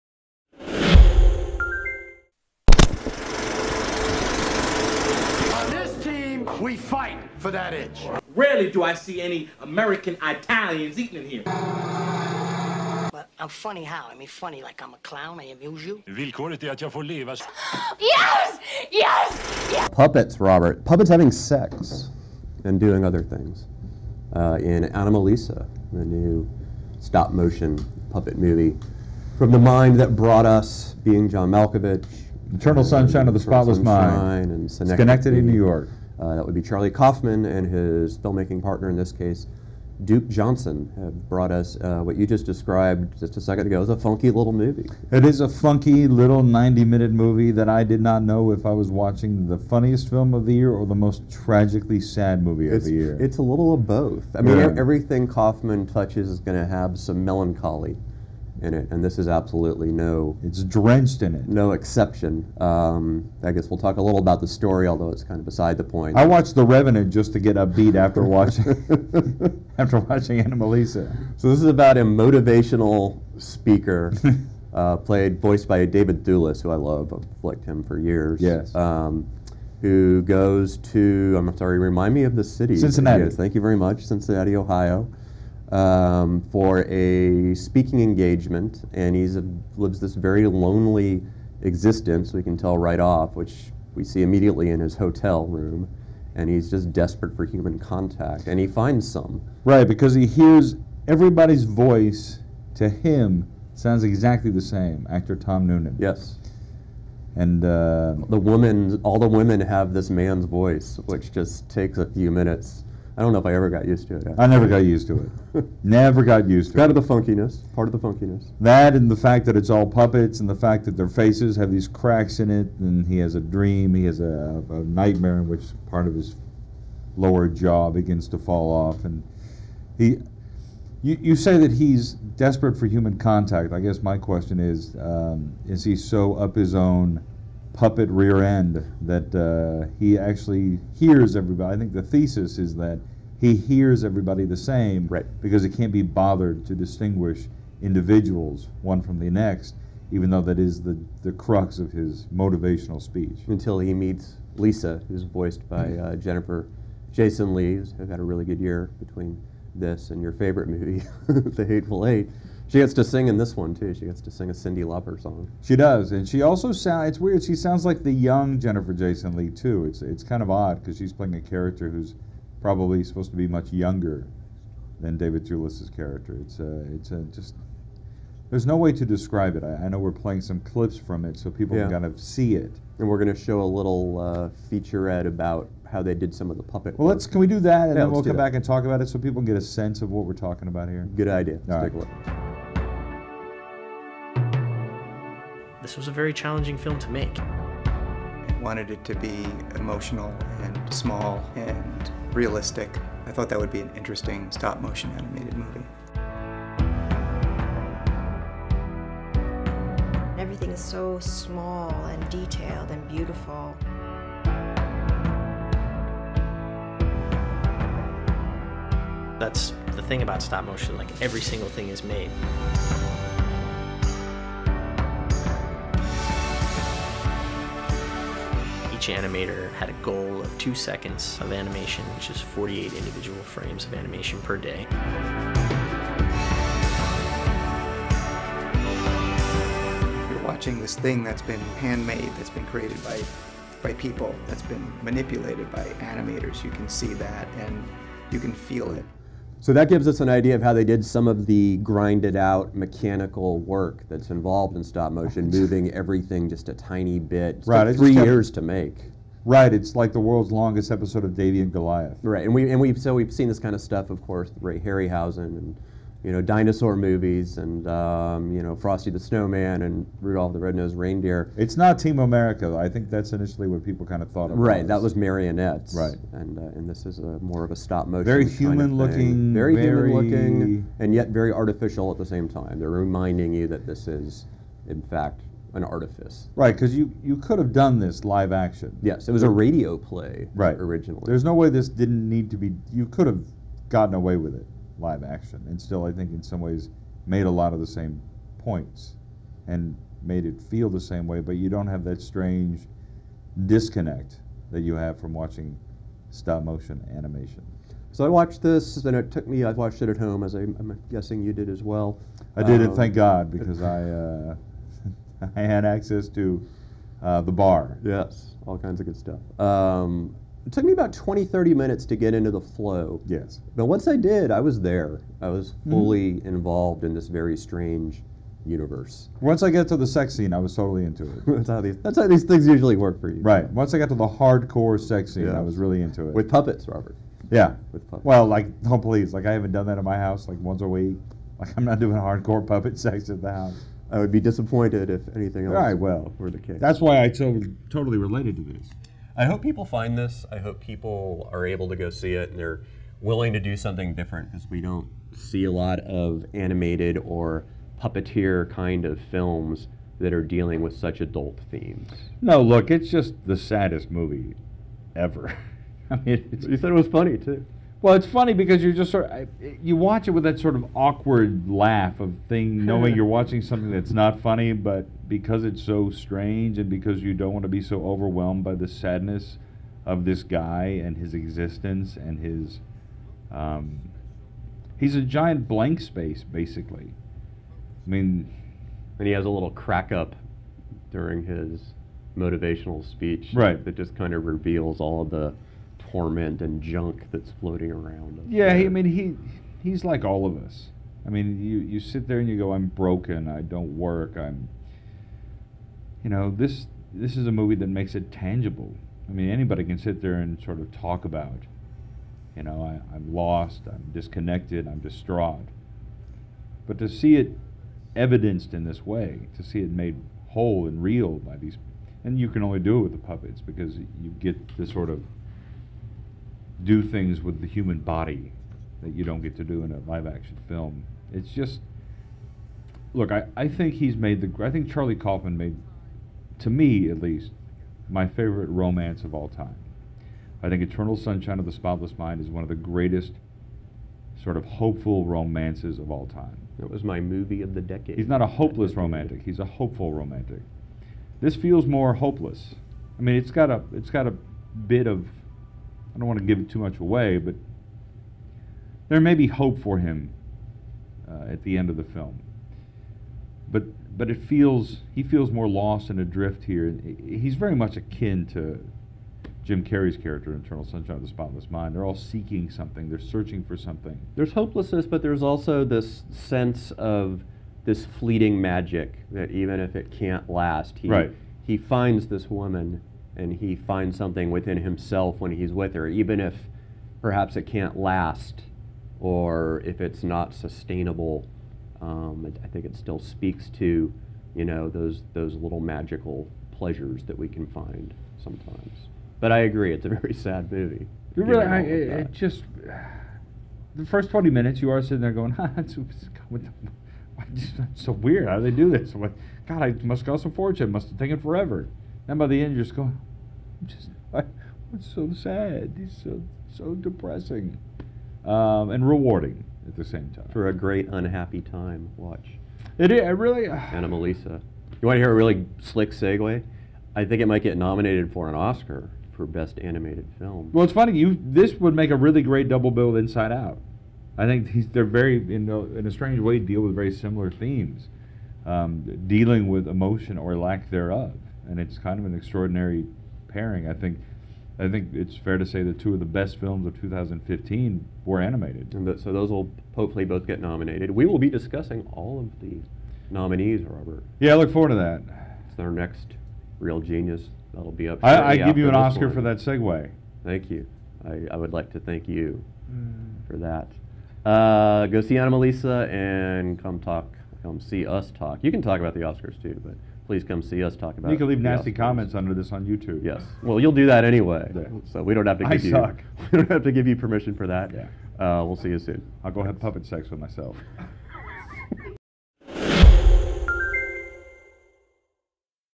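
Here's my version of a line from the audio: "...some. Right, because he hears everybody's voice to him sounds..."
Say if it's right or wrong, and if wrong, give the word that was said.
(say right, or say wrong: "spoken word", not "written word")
right.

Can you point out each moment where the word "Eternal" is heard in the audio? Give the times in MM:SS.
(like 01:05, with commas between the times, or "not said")
00:32, 07:20, 07:50.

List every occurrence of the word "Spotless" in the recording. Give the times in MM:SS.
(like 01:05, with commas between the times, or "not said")
00:33, 07:21, 07:51.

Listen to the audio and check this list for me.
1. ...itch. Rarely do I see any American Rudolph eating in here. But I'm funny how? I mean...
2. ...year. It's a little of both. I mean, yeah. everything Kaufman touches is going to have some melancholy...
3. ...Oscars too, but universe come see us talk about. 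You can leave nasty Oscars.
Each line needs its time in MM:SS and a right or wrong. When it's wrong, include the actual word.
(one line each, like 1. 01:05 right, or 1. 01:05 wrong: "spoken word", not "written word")
1. 00:07 wrong: "Italians", not "Rudolph"
2. 00:52 right
3. 09:29 wrong: "please", not "universe".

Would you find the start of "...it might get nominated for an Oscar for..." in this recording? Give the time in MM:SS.
08:47.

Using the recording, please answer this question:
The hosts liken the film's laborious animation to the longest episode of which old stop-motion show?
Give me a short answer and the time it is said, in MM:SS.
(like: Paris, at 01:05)
Davey and Goliath, at 04:21.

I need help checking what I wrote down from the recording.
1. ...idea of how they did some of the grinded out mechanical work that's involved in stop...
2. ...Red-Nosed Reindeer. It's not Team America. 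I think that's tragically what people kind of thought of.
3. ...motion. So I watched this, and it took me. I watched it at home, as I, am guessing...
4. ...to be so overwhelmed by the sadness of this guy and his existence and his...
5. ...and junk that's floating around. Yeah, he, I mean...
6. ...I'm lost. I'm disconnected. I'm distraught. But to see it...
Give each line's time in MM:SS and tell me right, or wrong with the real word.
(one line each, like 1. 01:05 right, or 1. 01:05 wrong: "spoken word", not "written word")
1. 04:10 right
2. 04:30 wrong: "initially", not "tragically"
3. 05:07 wrong: "animation", not "motion"
4. 06:17 right
5. 06:36 right
6. 06:53 right.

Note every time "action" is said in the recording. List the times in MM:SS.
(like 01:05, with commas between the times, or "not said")
04:48, 04:55, 07:10.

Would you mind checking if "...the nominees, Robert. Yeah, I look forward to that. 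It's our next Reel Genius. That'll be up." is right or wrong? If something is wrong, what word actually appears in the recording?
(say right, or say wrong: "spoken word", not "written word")
right.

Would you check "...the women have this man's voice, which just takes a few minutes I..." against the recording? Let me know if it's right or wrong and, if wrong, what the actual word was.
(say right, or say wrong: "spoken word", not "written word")
right.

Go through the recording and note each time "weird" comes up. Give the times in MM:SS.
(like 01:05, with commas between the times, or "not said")
02:47, 08:28.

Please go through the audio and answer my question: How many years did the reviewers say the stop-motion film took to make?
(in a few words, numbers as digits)
3 years.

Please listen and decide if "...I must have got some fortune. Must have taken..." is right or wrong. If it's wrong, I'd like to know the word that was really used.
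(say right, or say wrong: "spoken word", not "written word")
right.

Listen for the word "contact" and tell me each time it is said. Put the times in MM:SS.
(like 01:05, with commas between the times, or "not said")
01:37, 02:13.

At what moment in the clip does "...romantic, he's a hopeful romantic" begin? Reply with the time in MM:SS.
07:28.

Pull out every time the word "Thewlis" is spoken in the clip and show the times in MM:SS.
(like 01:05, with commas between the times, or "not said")
01:16, 02:55.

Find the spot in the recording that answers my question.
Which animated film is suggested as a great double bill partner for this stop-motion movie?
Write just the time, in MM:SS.
08:53.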